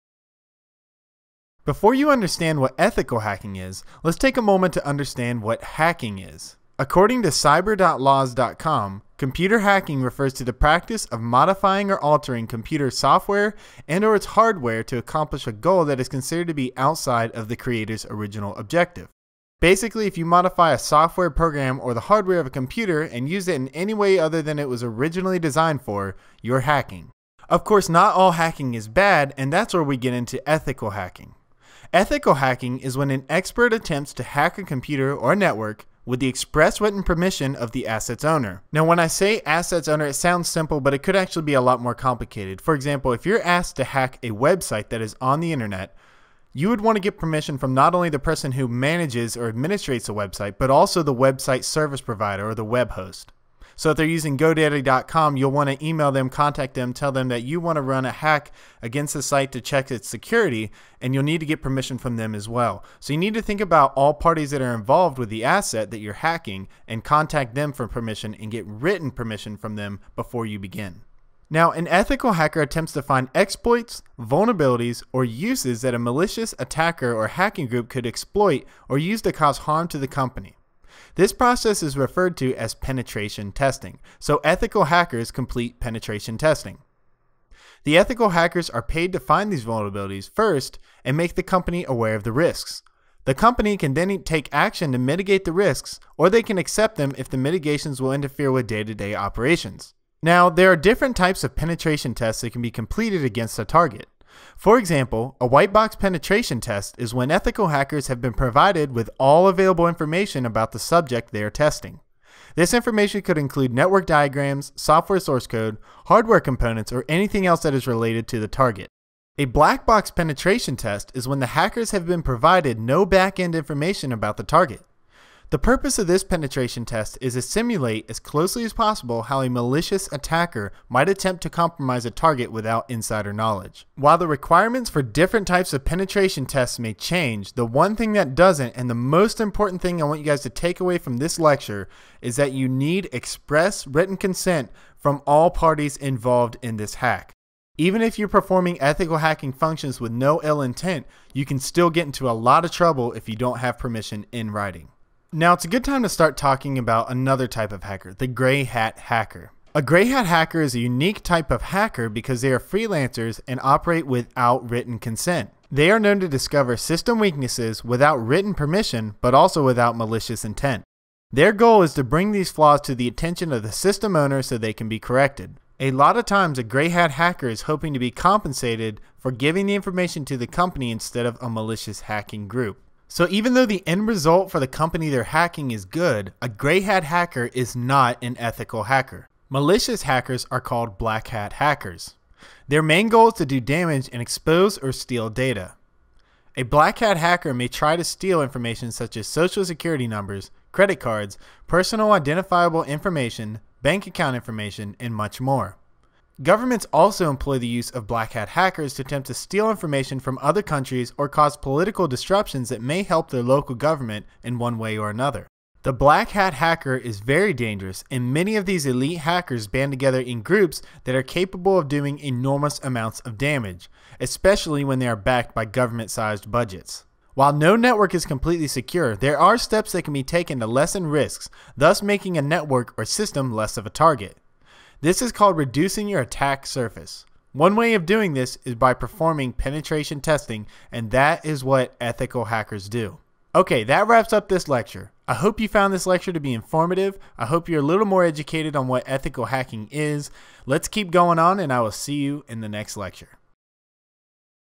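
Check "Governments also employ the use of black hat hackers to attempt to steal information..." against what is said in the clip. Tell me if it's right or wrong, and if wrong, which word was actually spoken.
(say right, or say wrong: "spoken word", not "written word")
right.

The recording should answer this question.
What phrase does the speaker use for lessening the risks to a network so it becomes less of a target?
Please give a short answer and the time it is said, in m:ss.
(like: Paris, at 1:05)
reducing your attack surface, at 3:55.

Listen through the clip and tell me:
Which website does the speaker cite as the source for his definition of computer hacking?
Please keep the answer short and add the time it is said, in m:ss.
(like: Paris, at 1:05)
cyber.laws.com, at 0:07.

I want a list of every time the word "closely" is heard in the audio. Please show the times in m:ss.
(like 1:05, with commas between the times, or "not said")
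2:08.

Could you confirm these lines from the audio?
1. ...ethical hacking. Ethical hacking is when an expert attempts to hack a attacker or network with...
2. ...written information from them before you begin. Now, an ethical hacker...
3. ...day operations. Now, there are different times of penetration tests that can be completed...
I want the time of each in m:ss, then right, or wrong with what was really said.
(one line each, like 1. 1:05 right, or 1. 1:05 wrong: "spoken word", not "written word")
1. 0:30 wrong: "computer", not "attacker"
2. 1:08 wrong: "permission", not "information"
3. 1:38 wrong: "types", not "times".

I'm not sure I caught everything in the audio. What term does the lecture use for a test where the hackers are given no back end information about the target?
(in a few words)
black box penetration test.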